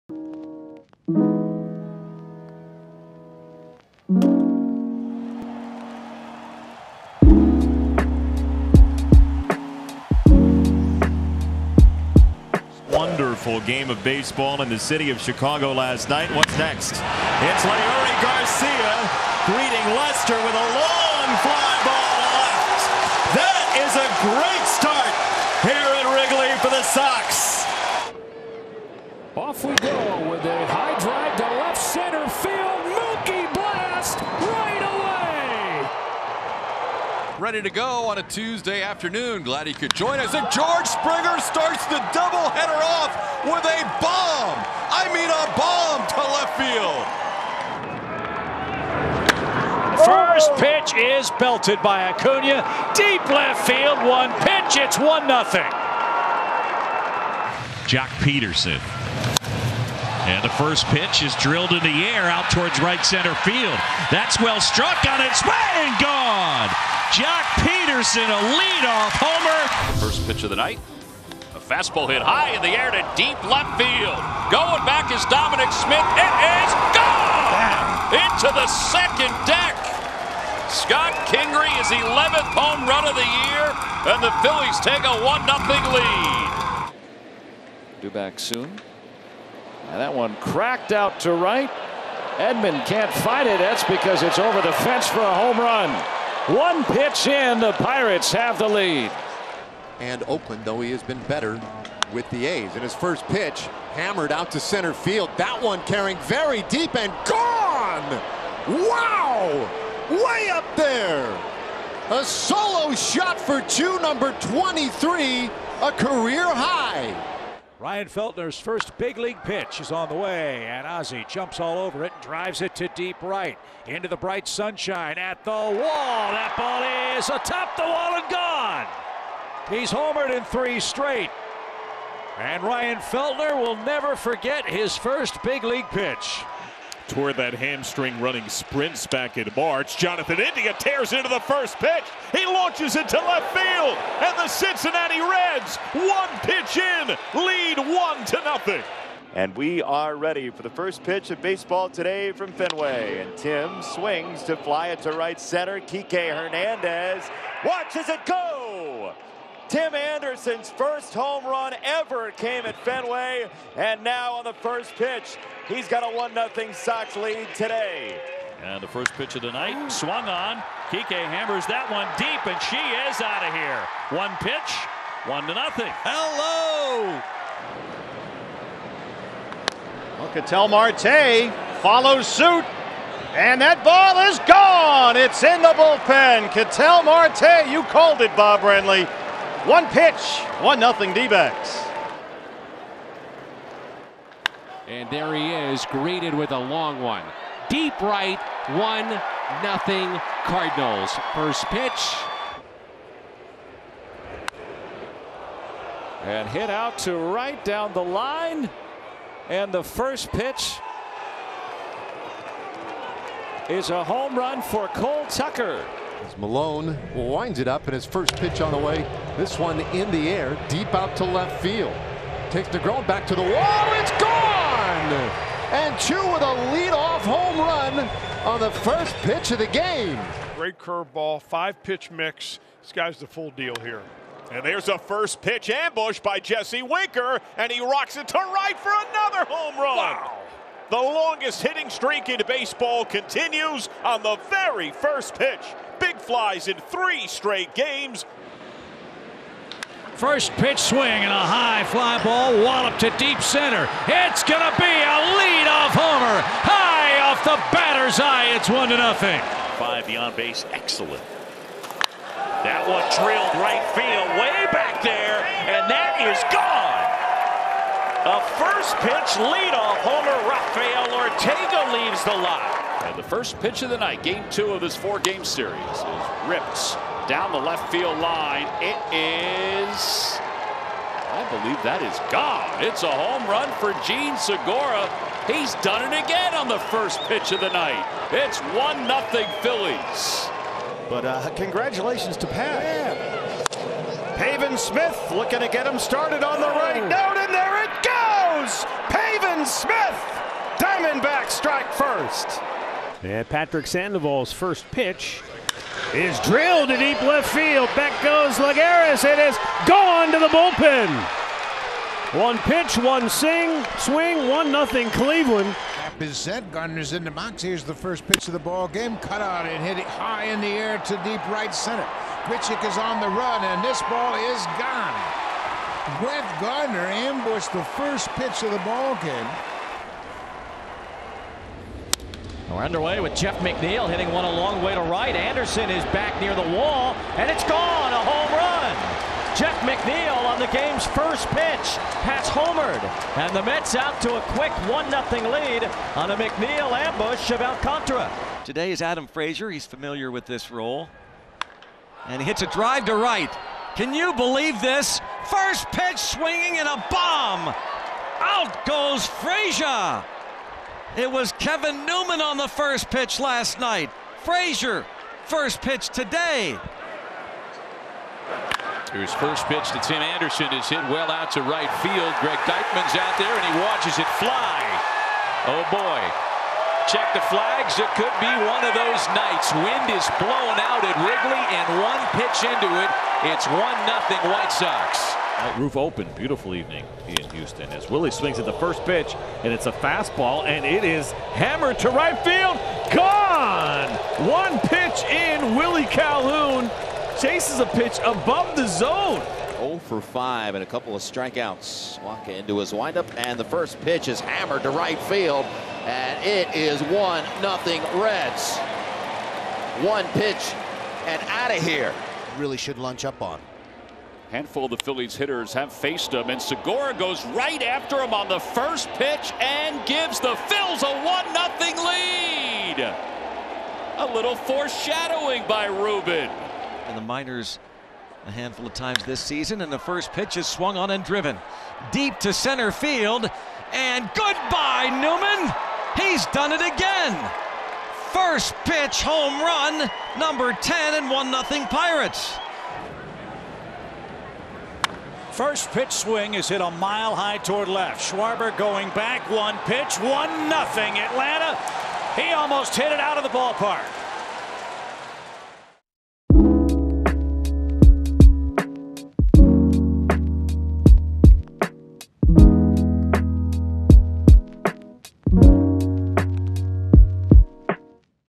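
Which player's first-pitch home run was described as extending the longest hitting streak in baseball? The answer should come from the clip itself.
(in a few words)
Jesse Winker.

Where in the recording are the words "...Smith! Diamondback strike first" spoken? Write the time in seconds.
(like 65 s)
299 s.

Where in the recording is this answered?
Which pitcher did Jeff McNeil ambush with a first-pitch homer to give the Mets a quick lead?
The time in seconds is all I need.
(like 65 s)
347 s.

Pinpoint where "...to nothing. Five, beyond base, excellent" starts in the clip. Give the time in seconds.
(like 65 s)
258 s.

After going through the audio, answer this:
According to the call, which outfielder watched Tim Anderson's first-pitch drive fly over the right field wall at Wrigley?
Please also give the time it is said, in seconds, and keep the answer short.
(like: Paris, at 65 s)
Greg Deichmann, at 372 s.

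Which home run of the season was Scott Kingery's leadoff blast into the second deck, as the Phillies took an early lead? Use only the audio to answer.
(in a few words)
11th.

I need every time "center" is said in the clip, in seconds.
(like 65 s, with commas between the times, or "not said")
31 s, 63 s, 104 s, 155 s, 253 s, 321 s, 432 s.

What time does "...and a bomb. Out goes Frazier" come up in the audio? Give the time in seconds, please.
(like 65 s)
356 s.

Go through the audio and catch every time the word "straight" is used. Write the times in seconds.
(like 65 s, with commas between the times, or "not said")
130 s, 247 s.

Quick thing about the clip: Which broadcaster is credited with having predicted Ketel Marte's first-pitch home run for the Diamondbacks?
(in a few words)
Bob Brenly.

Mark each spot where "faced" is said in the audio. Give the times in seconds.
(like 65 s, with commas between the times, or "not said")
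415 s.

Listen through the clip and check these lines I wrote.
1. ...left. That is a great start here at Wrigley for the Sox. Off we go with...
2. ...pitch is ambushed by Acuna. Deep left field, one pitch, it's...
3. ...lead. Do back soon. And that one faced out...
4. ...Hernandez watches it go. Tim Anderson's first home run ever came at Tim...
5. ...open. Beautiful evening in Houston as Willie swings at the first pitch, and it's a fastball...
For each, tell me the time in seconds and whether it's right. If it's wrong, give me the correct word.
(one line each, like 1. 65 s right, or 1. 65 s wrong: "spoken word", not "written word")
1. 22 s right
2. 50 s wrong: "belted", not "ambushed"
3. 85 s wrong: "cracked", not "faced"
4. 156 s wrong: "Fenway", not "Tim"
5. 385 s right.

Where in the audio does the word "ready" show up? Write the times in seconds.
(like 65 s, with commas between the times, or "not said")
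37 s, 150 s.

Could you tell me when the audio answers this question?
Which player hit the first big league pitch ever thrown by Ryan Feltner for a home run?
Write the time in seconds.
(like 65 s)
120 s.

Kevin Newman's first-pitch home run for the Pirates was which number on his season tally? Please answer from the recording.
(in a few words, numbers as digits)
10.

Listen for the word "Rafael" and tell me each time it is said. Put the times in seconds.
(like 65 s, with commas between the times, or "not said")
270 s.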